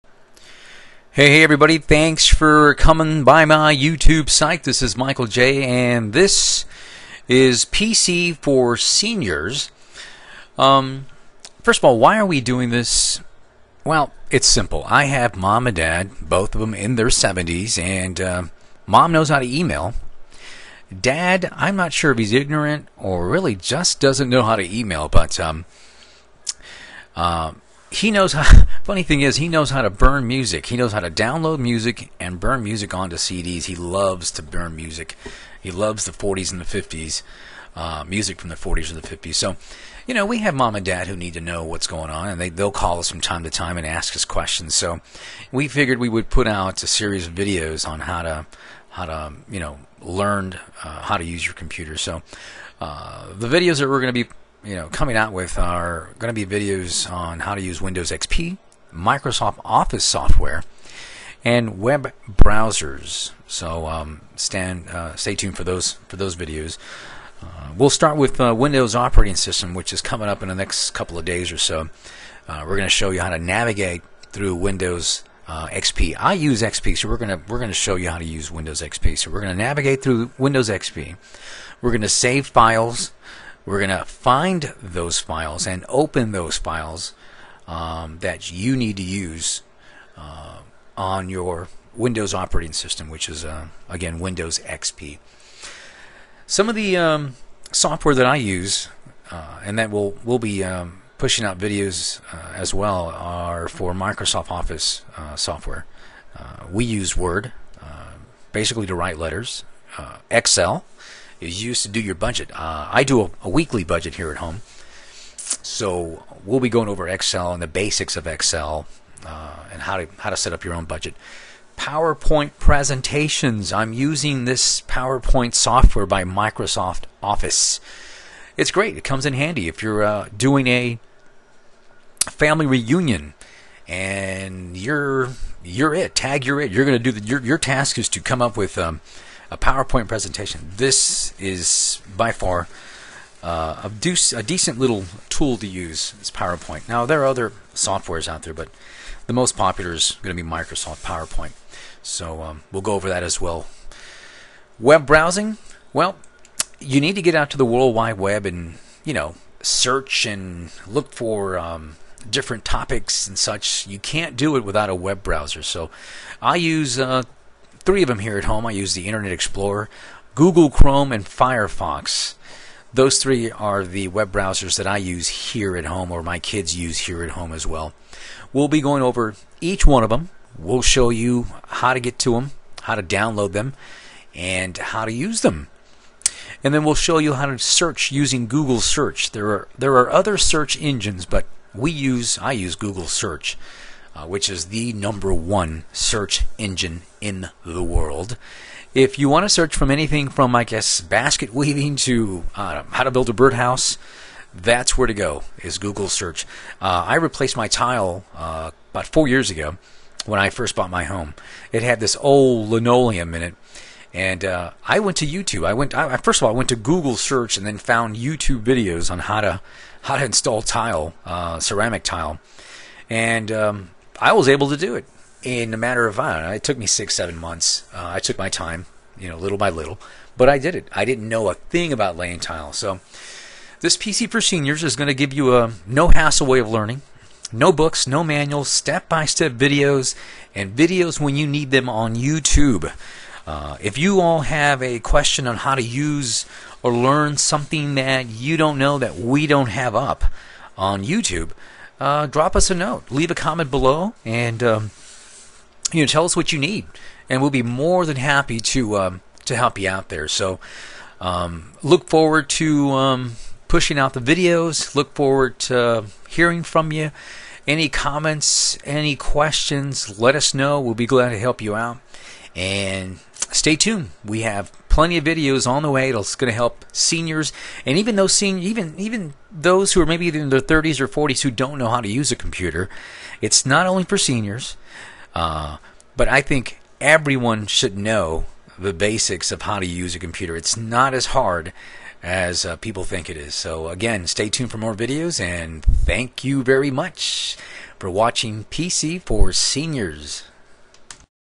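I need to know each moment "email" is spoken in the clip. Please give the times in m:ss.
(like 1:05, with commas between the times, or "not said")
0:19, 0:24.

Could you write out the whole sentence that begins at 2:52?
Those three are the web browsers that I use here at home, or my kids use here at home as well.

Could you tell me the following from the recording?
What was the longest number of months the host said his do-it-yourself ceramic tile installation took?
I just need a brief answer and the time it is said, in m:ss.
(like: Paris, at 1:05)
7, at 3:47.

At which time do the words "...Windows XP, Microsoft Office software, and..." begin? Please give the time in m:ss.
0:57.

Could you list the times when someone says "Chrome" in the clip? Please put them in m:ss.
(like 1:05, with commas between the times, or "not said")
2:50.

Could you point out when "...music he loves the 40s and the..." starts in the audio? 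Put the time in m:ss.
0:34.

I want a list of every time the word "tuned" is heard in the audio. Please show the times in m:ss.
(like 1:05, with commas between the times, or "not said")
1:05, 4:33, 4:54.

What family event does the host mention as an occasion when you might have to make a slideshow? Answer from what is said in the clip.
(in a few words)
family reunion.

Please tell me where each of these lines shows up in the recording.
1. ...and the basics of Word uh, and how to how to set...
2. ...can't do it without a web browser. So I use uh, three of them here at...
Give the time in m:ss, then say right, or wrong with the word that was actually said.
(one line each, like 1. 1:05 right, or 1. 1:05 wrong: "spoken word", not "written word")
1. 1:57 wrong: "Excel", not "Word"
2. 2:43 right.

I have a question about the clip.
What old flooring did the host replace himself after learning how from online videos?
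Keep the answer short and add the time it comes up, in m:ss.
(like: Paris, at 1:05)
linoleum, at 3:32.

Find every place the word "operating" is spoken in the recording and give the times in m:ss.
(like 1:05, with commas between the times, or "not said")
1:08, 1:32.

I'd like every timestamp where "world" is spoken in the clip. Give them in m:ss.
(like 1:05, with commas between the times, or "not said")
2:37, 3:17.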